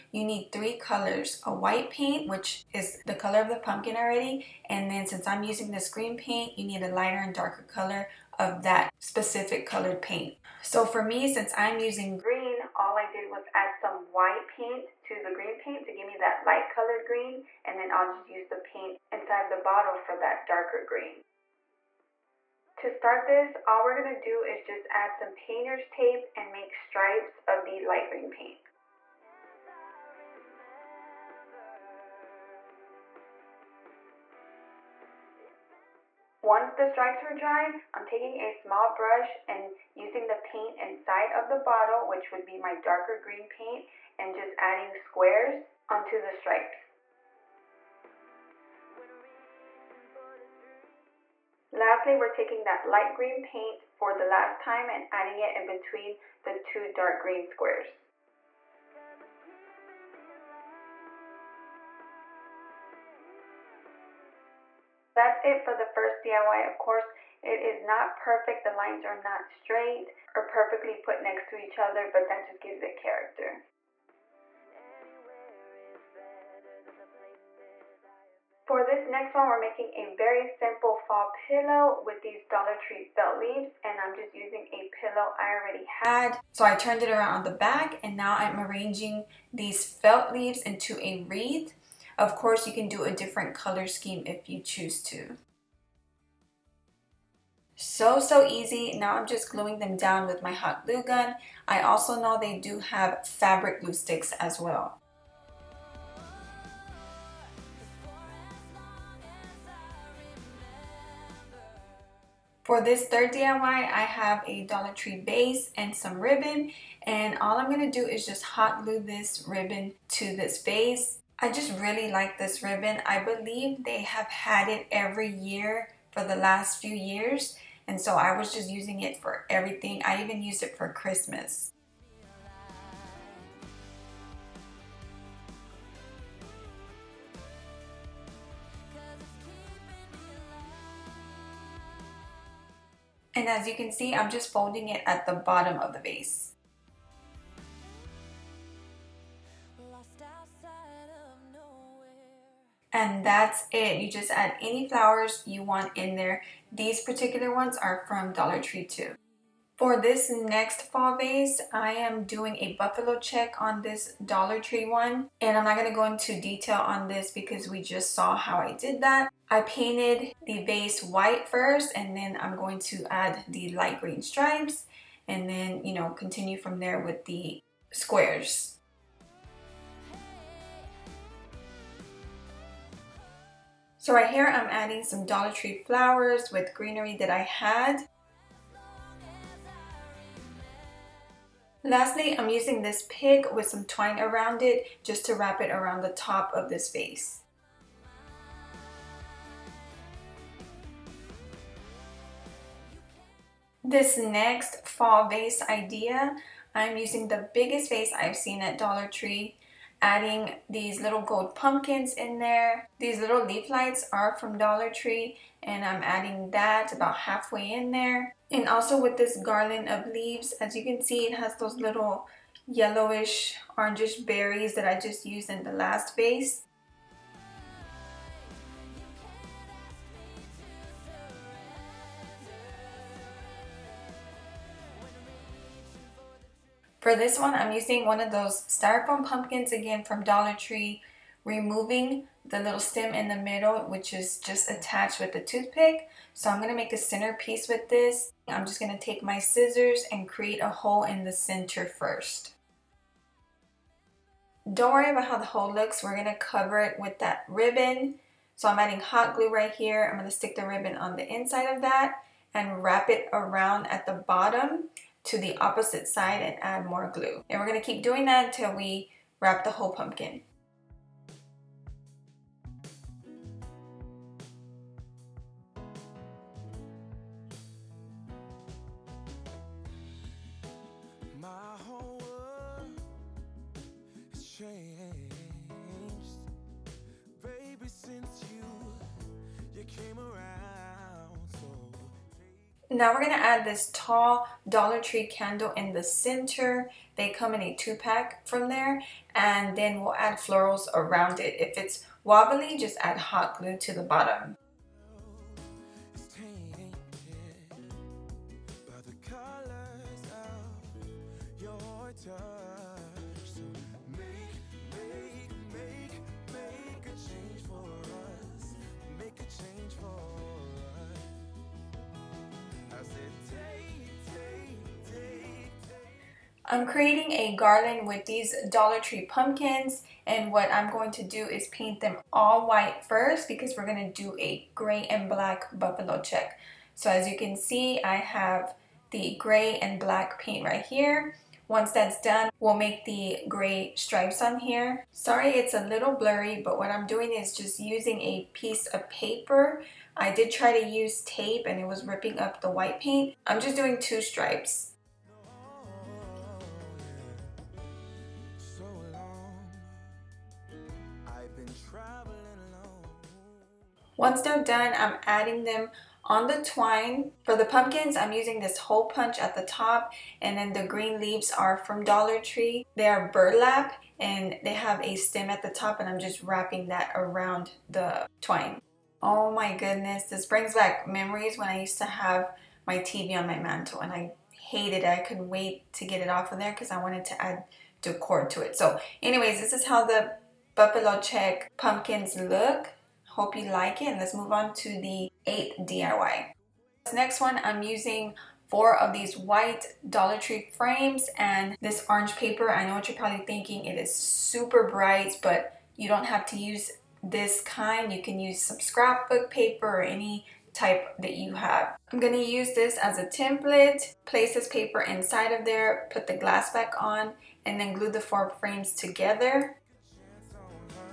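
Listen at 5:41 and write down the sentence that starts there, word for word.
Once that's done, we'll make the gray stripes on here.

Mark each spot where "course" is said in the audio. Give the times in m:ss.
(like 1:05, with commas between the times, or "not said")
1:06, 1:32.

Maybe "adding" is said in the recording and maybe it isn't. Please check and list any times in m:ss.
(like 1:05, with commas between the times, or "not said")
0:44, 0:55, 3:04, 3:30, 3:36, 4:18, 6:05.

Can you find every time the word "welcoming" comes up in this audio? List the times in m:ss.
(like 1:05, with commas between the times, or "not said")
not said.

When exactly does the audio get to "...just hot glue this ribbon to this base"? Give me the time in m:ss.
1:58.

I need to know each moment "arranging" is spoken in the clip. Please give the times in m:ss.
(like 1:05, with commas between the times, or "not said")
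1:28.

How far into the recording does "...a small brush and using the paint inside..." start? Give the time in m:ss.
0:38.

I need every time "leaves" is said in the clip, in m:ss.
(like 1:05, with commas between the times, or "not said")
1:23, 1:30, 3:40, 6:11.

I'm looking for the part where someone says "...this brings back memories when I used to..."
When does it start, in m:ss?
6:20.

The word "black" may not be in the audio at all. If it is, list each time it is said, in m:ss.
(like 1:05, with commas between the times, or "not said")
5:35, 5:39.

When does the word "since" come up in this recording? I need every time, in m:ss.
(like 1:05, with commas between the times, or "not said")
0:05, 0:11.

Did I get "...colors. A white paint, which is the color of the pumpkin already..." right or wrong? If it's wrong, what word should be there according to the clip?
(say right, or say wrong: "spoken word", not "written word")
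right.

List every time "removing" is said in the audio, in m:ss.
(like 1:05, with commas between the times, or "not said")
4:01.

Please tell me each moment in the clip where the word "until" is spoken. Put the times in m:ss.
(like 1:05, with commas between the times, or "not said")
4:28.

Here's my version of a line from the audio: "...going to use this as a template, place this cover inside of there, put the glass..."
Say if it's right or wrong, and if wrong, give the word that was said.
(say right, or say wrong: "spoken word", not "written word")
wrong: "paper", not "cover".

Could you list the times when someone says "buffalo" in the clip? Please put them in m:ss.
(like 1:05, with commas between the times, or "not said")
2:42, 5:35, 6:30.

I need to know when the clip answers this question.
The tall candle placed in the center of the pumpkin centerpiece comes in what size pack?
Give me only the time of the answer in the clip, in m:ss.
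4:57.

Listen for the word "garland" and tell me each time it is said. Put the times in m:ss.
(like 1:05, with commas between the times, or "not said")
3:39, 5:27.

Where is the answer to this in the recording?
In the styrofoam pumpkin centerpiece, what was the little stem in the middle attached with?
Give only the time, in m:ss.
4:05.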